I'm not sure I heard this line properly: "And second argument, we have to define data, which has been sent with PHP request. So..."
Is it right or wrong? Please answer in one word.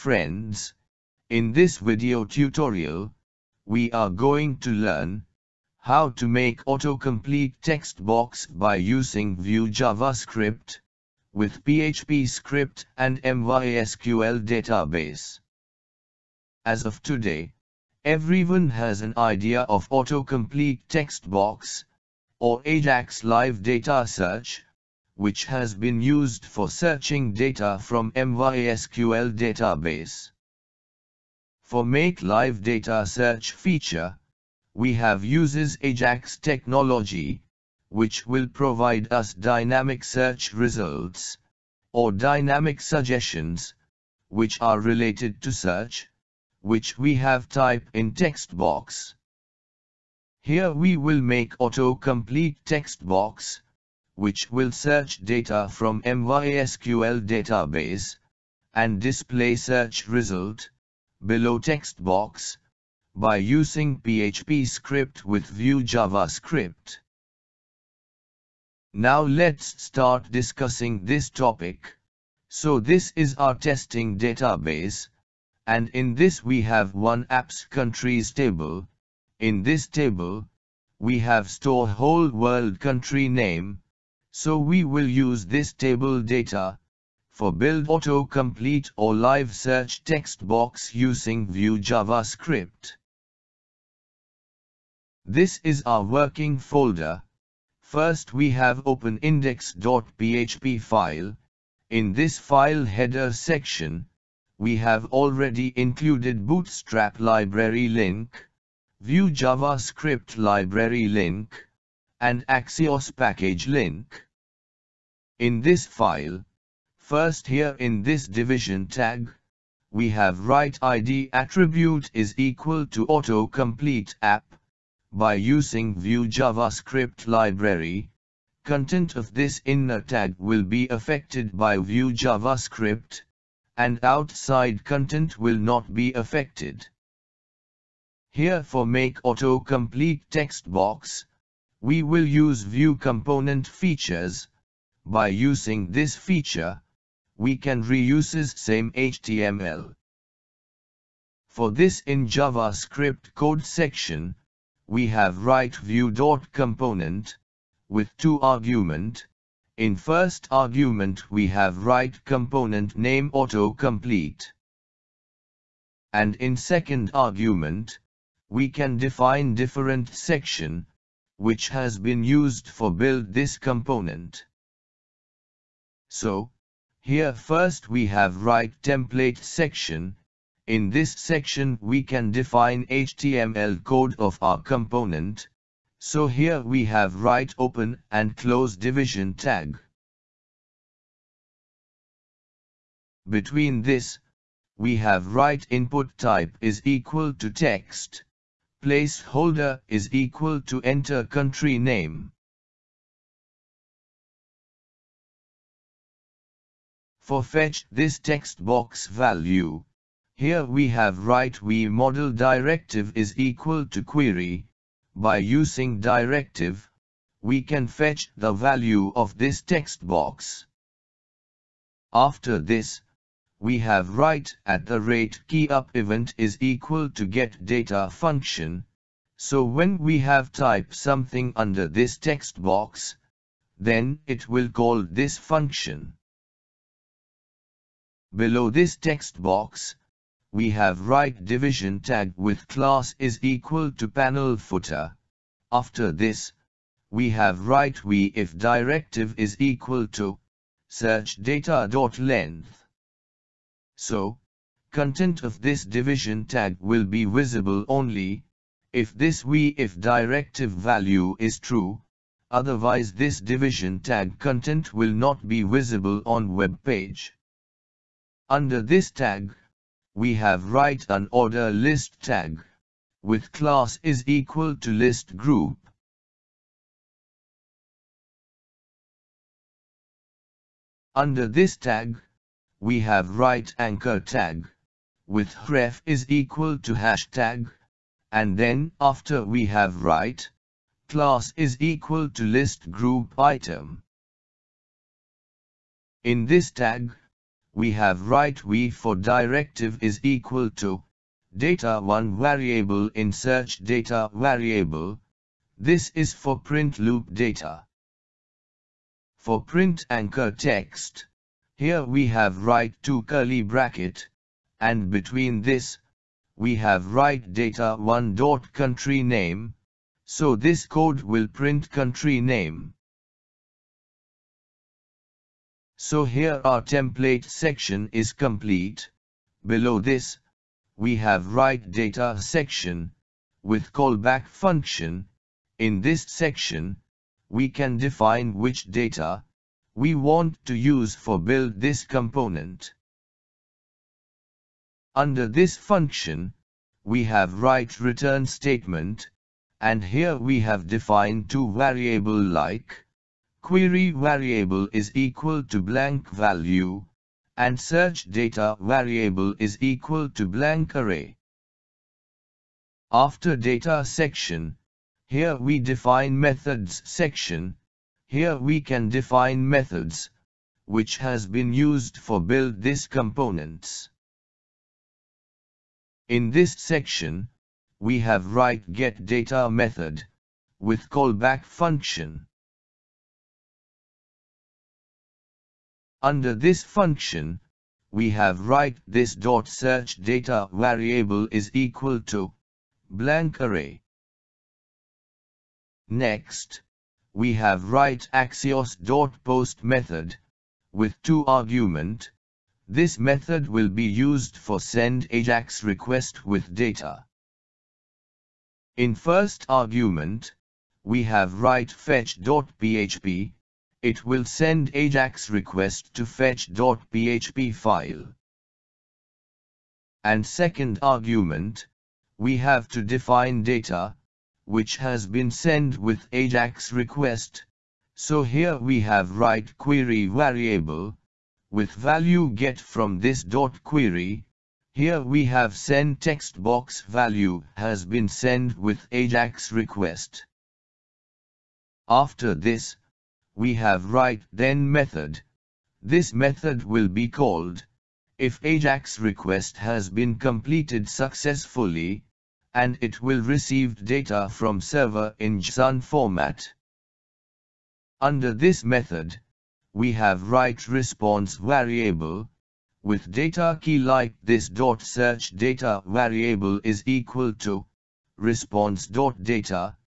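wrong.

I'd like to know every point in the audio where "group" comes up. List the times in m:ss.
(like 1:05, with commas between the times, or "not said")
4:35, 4:52.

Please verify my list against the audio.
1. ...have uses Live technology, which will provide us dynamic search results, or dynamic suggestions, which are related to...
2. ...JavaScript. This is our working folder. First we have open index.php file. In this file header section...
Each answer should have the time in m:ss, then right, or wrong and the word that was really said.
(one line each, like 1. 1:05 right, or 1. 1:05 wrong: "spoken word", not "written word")
1. 0:34 wrong: "Ajax", not "Live"
2. 1:31 right.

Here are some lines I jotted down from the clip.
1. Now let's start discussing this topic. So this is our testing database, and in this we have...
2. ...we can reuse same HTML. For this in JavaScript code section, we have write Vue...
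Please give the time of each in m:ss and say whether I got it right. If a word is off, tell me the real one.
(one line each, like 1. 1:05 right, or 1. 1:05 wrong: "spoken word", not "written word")
1. 1:08 right
2. 2:27 right.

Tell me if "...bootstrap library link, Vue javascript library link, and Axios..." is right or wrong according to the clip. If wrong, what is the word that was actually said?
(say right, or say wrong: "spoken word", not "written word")
right.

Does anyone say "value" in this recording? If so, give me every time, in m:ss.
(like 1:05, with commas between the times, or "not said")
3:29, 3:38, 4:20, 5:56, 7:11, 7:17.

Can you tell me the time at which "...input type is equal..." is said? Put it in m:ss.
3:15.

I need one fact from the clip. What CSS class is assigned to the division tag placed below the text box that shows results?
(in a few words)
panel footer.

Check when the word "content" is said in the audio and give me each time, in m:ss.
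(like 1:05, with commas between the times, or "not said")
2:08, 2:14, 4:14, 4:24.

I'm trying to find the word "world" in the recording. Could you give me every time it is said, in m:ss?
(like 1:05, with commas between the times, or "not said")
1:22.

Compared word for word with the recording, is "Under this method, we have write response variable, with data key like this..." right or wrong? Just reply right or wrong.
right.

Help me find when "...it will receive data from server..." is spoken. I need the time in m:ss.
7:33.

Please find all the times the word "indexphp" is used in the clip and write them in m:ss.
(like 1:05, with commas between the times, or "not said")
1:39.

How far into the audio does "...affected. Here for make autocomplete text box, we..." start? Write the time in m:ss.
2:16.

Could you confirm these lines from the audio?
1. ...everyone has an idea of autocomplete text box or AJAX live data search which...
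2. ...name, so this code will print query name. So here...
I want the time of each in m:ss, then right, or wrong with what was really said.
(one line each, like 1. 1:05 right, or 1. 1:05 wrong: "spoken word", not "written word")
1. 0:18 right
2. 5:19 wrong: "country", not "query".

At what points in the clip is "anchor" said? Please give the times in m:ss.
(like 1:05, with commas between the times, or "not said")
4:43, 5:10.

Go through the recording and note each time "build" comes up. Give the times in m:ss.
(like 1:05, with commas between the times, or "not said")
1:27, 2:52, 5:41, 6:12.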